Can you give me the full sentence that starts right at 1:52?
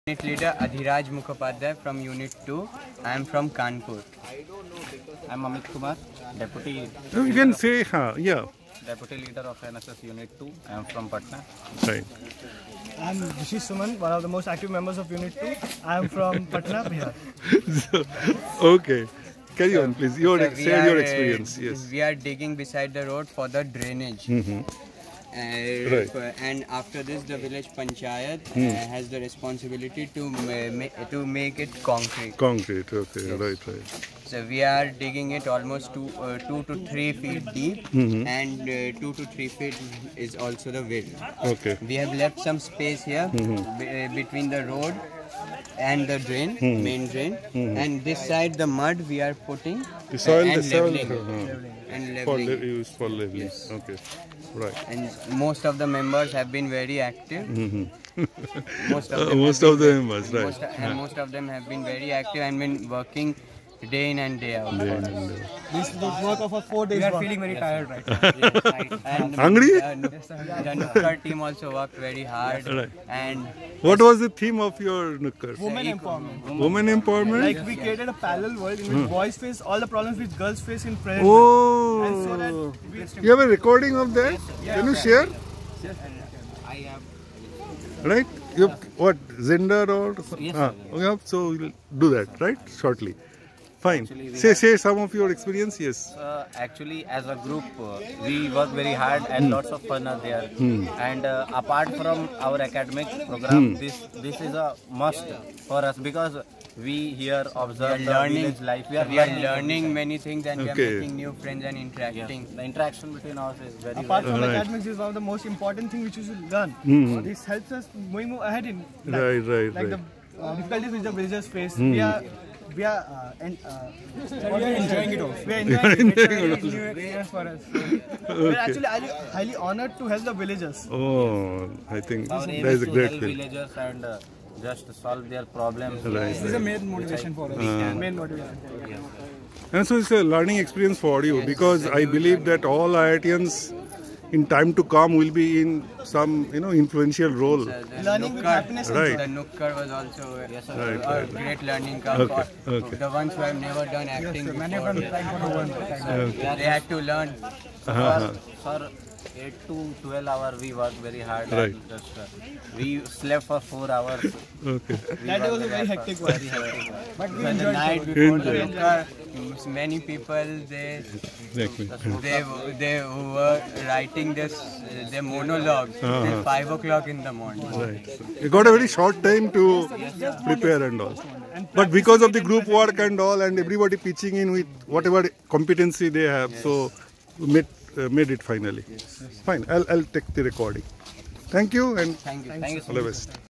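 The interaction between us is very Apart from right.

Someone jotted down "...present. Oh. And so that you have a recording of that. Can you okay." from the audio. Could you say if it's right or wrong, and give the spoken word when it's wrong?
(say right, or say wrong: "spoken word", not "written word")
right.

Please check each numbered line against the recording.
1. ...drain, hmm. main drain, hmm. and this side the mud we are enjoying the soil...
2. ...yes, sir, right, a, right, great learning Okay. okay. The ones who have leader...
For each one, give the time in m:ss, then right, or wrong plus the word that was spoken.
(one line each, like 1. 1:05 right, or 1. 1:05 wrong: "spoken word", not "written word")
1. 0:46 wrong: "putting", not "enjoying"
2. 2:30 wrong: "never", not "leader".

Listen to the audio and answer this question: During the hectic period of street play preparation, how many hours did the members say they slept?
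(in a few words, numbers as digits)
4 hours.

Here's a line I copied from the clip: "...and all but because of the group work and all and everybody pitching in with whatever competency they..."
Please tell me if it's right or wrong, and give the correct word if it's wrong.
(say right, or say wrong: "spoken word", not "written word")
right.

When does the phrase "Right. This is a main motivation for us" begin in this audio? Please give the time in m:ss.
2:16.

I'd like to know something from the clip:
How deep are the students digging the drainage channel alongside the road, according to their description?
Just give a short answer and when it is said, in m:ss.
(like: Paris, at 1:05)
2 to 3 feet, at 0:36.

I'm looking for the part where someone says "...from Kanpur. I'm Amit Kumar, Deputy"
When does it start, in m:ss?
0:03.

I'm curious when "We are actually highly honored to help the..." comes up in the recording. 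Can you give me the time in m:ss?
2:08.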